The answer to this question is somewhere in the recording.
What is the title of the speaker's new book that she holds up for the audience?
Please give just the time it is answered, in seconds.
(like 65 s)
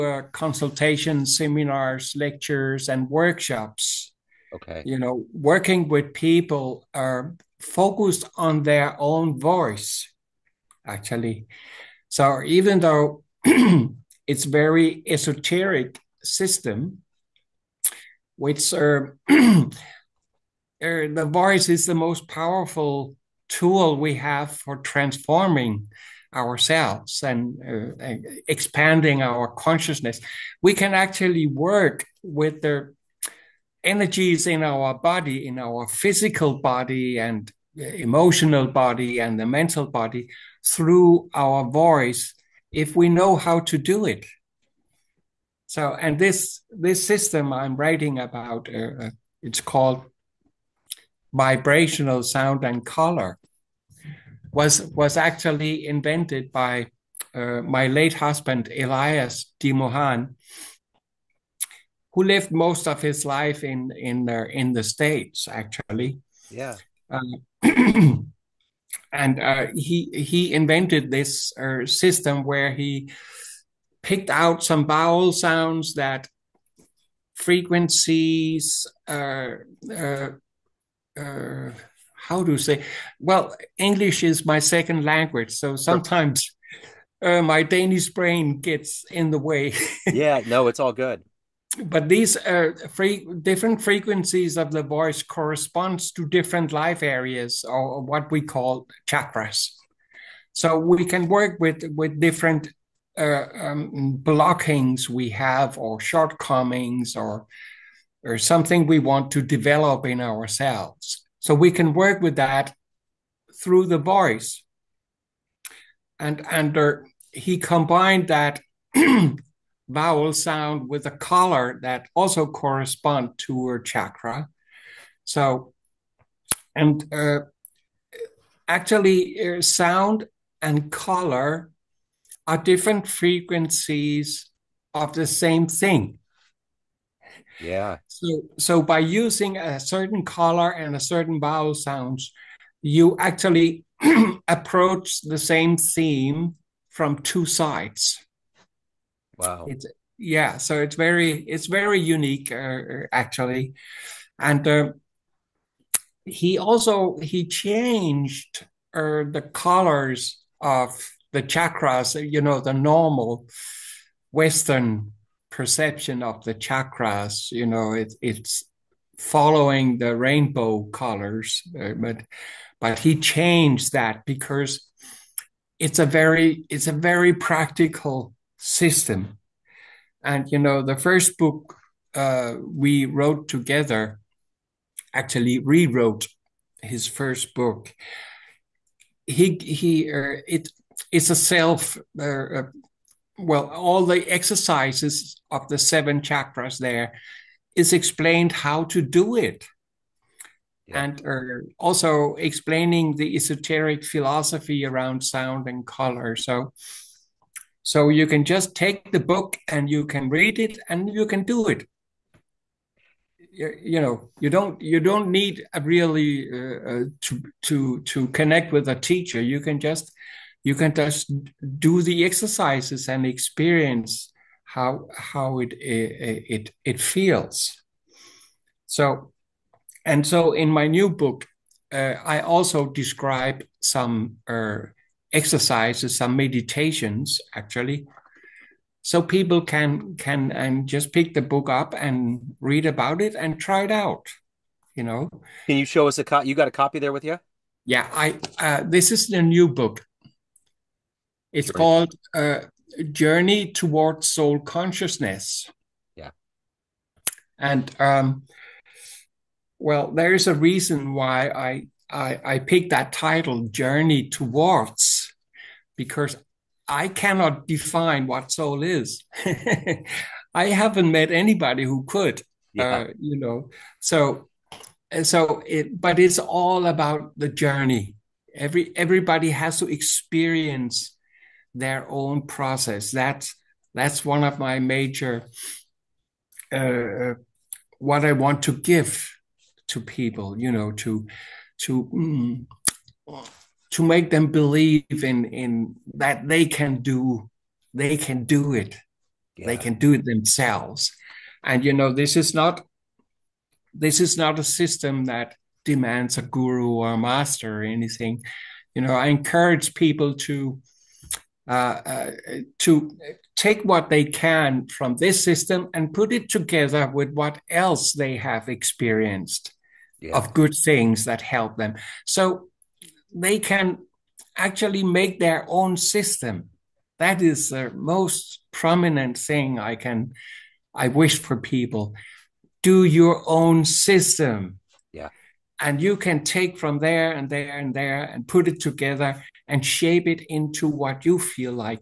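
253 s.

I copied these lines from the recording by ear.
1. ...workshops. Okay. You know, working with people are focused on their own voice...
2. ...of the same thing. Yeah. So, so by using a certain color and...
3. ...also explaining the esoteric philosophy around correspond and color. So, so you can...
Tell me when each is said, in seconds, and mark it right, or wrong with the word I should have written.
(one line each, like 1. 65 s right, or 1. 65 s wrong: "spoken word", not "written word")
1. 3 s right
2. 134 s right
3. 201 s wrong: "sound", not "correspond".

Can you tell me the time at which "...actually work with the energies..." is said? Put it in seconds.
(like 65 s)
30 s.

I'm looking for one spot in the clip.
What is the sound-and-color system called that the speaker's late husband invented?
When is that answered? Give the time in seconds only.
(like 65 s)
51 s.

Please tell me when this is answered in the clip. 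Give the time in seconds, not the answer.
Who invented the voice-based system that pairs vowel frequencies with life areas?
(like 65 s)
58 s.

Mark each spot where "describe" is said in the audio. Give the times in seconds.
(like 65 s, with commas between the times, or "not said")
232 s.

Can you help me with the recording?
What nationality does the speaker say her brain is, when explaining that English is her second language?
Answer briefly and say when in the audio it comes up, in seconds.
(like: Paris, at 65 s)
Danish, at 87 s.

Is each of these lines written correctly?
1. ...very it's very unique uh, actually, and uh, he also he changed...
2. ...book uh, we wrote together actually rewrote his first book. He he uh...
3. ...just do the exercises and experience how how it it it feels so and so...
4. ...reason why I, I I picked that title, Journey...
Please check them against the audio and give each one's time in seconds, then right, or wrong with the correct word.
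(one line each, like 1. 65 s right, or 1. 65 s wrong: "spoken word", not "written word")
1. 150 s right
2. 181 s right
3. 220 s right
4. 260 s right.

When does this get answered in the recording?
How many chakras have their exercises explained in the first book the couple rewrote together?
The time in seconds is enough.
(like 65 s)
195 s.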